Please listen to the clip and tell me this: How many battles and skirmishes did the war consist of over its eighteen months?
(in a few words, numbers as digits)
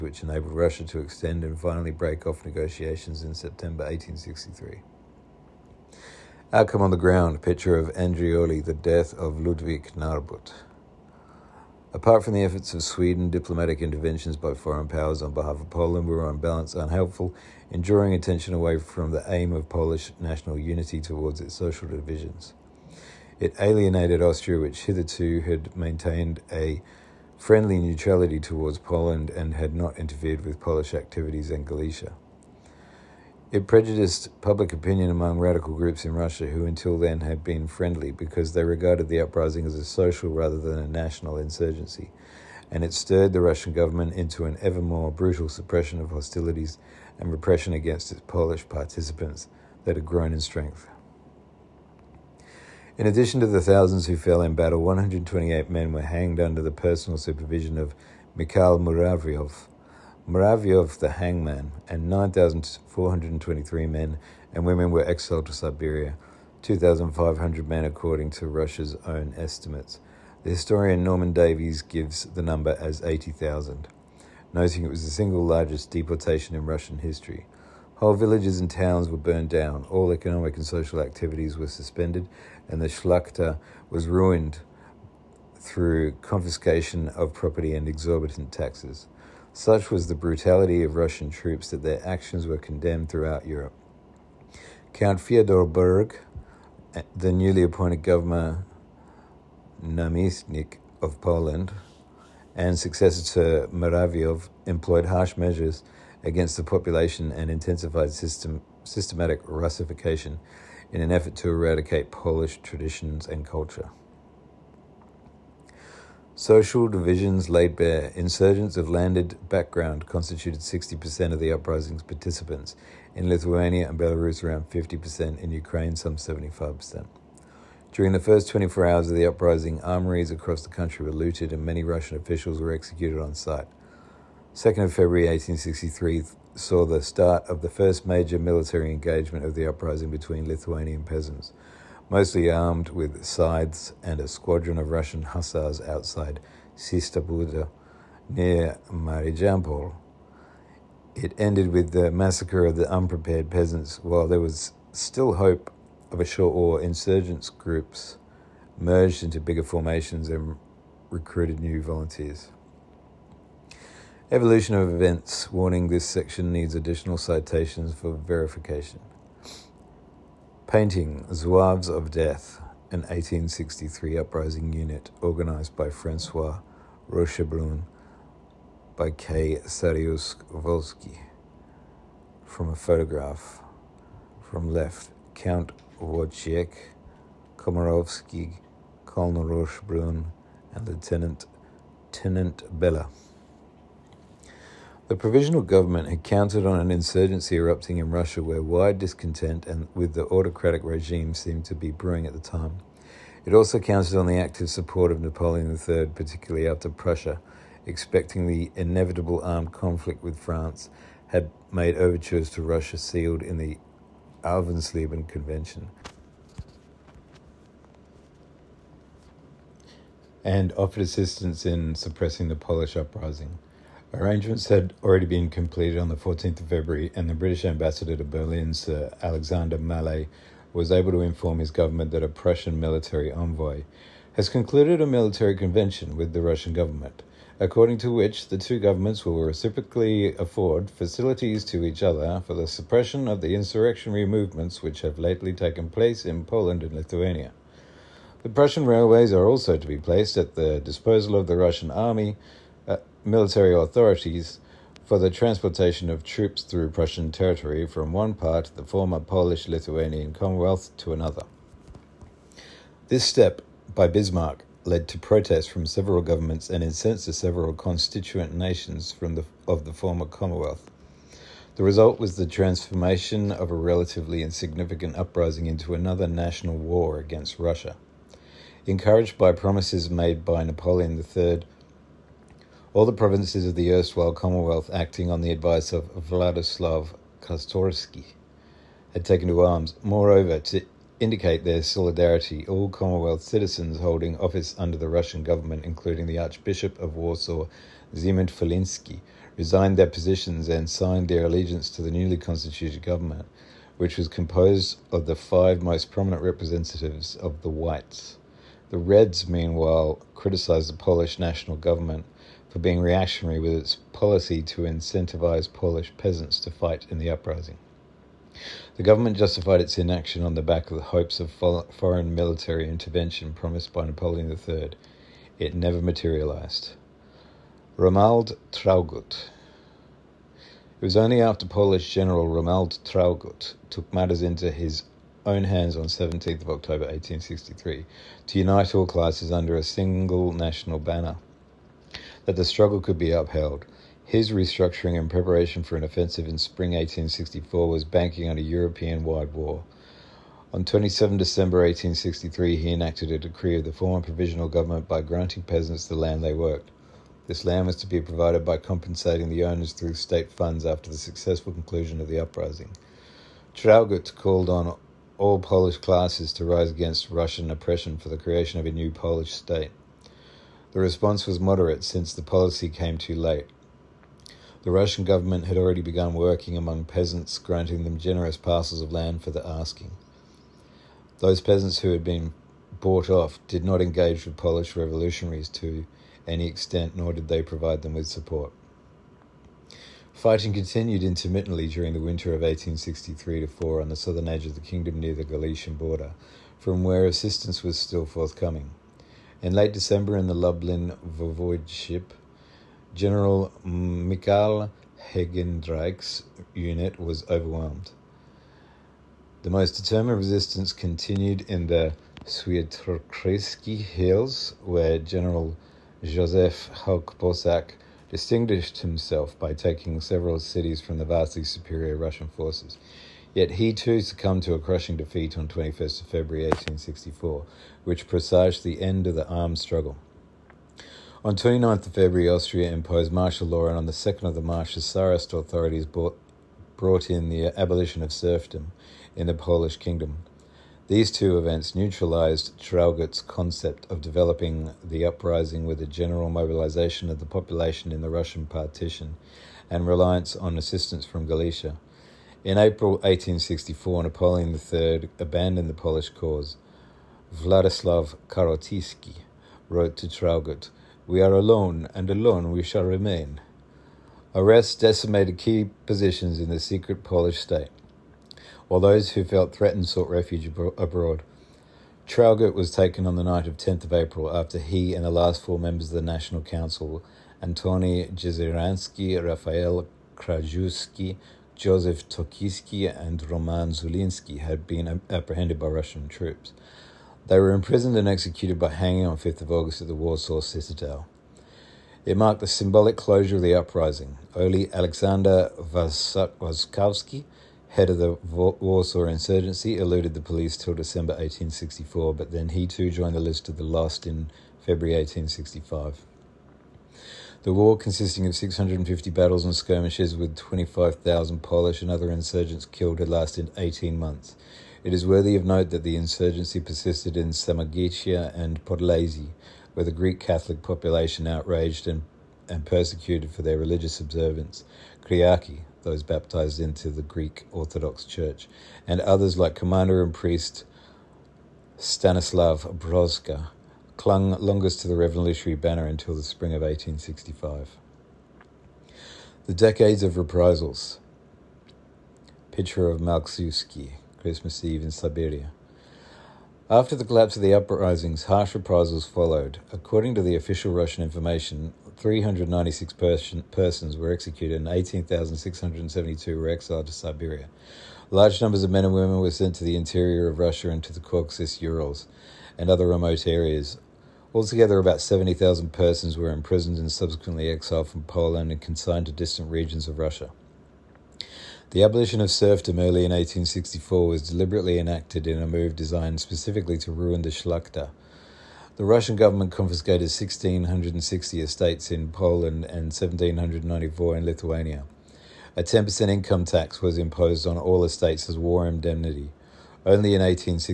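650.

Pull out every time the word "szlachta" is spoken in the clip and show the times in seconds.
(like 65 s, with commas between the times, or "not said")
82 s, 577 s.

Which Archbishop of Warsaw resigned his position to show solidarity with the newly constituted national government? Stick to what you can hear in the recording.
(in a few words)
Zygmunt Feliński.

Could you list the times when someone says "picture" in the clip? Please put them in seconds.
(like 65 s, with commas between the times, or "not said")
7 s, 542 s.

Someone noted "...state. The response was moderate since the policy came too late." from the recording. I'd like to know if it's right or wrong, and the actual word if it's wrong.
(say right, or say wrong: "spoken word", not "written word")
right.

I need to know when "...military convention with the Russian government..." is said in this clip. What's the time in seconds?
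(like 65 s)
235 s.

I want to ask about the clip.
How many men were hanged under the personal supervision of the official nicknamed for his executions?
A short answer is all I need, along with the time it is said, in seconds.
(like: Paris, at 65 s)
128, at 54 s.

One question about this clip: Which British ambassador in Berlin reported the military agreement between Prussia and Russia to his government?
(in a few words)
Sir Alexander Malet.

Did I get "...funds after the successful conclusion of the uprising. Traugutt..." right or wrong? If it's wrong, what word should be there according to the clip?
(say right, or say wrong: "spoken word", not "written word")
right.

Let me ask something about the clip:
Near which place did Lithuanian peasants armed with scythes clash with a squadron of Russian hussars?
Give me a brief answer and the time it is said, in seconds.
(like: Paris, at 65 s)
Čysta Būda, at 146 s.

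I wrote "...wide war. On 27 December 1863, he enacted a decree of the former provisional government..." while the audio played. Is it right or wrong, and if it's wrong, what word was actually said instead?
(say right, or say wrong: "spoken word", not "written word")
right.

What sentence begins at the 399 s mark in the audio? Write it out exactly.
In late December, in the Lublin Voivodeship, General Mikhail Heydenreich's unit was overwhelmed.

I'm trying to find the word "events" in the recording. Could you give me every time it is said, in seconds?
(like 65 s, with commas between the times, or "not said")
164 s, 441 s.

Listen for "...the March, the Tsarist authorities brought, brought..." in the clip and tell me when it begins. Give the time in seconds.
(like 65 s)
434 s.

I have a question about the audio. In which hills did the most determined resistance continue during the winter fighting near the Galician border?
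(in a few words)
Swiatrokreski Hills.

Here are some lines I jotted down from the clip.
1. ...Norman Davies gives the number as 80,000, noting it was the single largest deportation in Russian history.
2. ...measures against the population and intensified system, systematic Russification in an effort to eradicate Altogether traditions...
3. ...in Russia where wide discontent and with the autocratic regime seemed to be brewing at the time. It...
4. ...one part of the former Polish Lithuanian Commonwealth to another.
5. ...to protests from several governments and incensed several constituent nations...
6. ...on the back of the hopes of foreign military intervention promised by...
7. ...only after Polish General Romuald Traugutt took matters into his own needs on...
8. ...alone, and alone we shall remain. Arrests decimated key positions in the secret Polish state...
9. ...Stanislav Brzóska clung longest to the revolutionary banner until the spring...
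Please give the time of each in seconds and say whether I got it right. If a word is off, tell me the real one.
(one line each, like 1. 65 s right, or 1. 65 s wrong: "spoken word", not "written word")
1. 71 s right
2. 105 s wrong: "Polish", not "Altogether"
3. 197 s right
4. 258 s right
5. 265 s right
6. 320 s right
7. 331 s wrong: "hands", not "needs"
8. 461 s right
9. 531 s right.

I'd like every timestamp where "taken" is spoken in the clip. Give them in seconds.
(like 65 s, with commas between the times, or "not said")
245 s, 289 s, 472 s.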